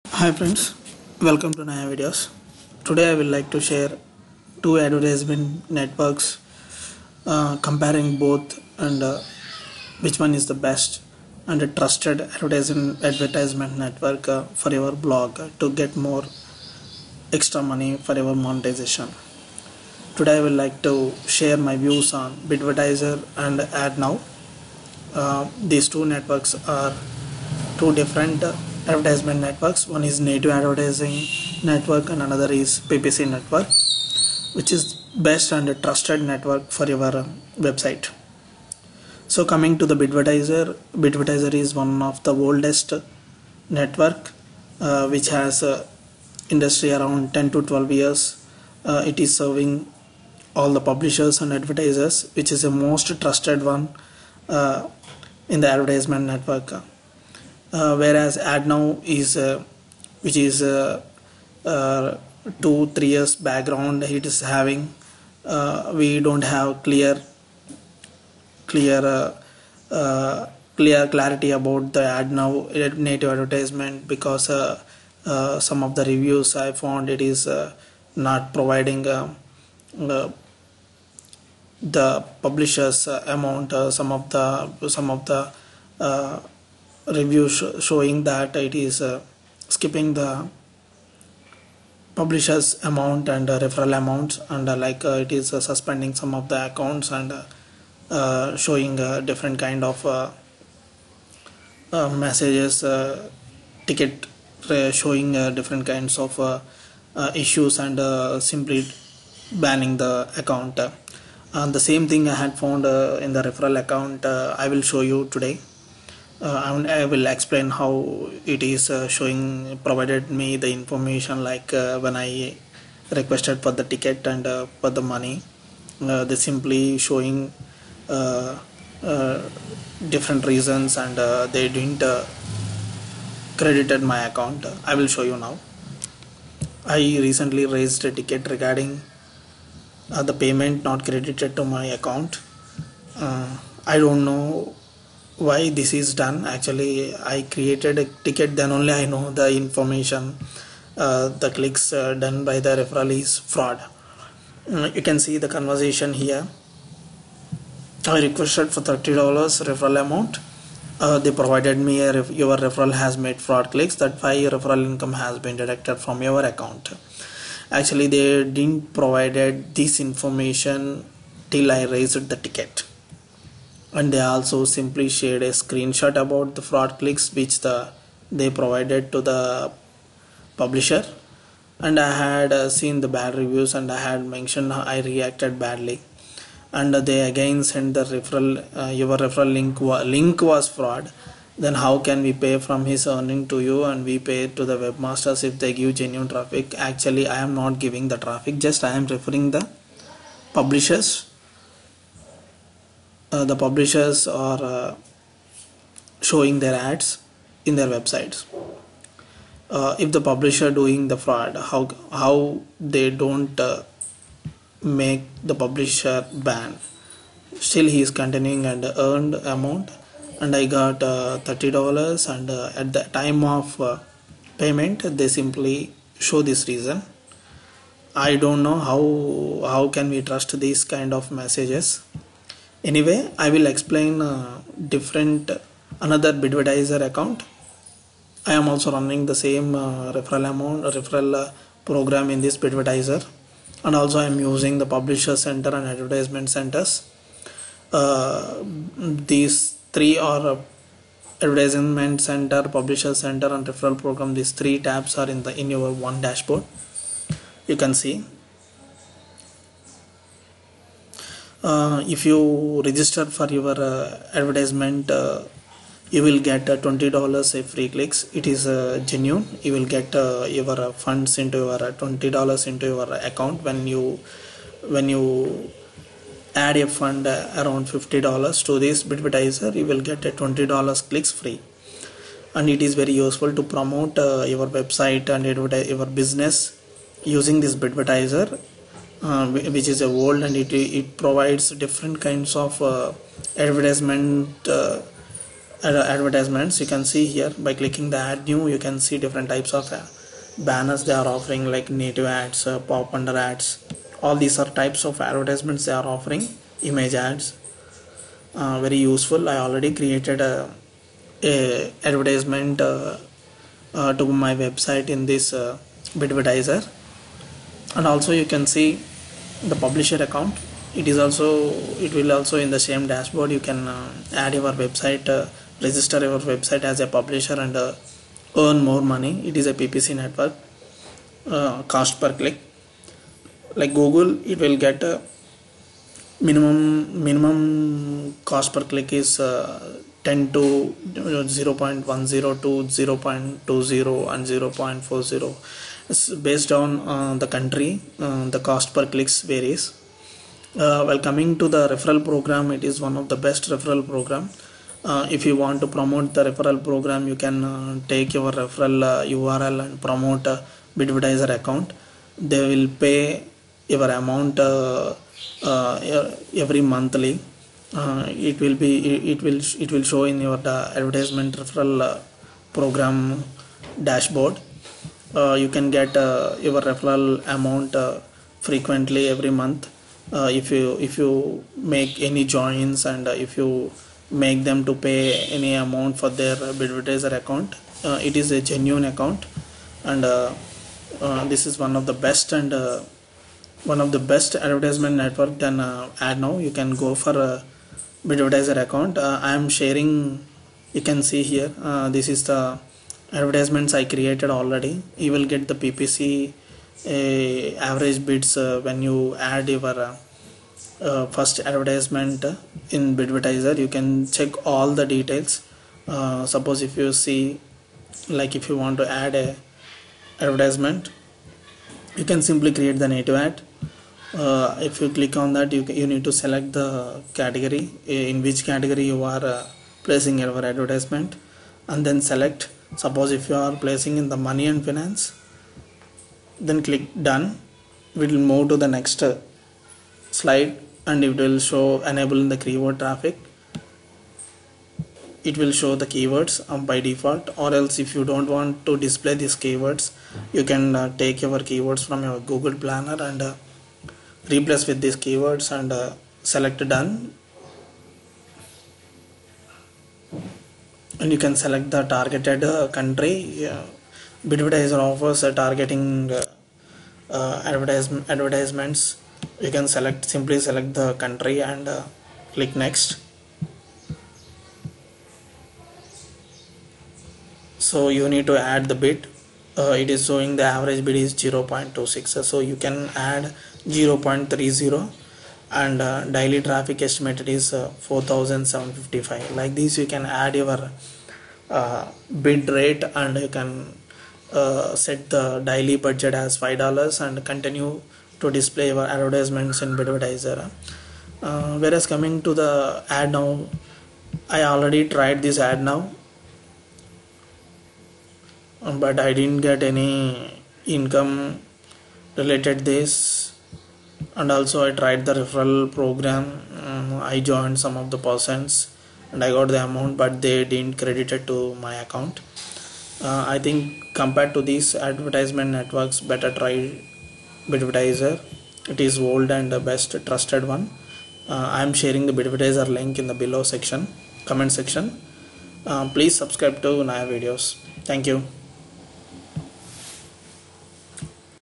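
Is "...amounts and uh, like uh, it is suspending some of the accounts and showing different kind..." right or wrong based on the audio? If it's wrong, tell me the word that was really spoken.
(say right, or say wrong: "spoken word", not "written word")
right.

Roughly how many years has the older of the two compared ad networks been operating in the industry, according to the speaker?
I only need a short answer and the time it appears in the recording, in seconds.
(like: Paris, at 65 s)
10 to 12 years, at 47 s.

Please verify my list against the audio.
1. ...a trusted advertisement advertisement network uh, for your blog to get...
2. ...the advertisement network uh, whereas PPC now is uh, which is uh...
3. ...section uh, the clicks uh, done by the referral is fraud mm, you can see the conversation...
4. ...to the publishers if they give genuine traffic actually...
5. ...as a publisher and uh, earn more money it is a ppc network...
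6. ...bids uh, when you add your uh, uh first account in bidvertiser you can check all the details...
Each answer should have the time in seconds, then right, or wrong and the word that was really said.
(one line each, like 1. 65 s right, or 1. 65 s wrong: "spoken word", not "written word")
1. 11 s right
2. 55 s wrong: "Adnow", not "PPC"
3. 149 s wrong: "information", not "section"
4. 194 s wrong: "webmasters", not "publishers"
5. 326 s right
6. 408 s wrong: "advertisement", not "account".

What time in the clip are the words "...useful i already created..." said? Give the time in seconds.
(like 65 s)
308 s.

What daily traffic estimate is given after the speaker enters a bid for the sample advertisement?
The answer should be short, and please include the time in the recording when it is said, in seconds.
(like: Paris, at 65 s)
4755, at 488 s.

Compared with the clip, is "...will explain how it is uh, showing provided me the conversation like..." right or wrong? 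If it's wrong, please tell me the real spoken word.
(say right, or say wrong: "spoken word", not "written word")
wrong: "information", not "conversation".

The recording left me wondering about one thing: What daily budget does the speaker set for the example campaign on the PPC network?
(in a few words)
$5.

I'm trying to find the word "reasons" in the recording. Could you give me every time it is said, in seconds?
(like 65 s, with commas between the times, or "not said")
130 s, 226 s.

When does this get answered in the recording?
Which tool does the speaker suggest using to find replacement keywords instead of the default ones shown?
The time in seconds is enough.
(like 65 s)
452 s.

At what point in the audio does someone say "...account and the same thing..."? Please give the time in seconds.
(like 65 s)
110 s.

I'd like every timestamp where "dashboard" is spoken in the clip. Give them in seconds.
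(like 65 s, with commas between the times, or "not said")
256 s, 323 s, 374 s.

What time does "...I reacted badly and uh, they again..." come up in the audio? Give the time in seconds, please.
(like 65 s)
184 s.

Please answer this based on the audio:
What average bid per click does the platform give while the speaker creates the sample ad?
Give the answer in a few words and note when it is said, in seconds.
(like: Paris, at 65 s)
0.26, at 481 s.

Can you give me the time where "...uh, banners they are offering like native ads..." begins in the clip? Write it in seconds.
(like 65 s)
299 s.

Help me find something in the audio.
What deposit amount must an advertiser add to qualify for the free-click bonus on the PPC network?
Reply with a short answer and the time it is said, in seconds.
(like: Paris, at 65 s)
$50, at 277 s.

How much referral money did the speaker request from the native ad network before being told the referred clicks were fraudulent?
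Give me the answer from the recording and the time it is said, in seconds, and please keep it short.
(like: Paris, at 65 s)
$30, at 158 s.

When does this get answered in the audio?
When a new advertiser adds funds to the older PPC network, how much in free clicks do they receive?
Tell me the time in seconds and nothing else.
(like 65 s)
266 s.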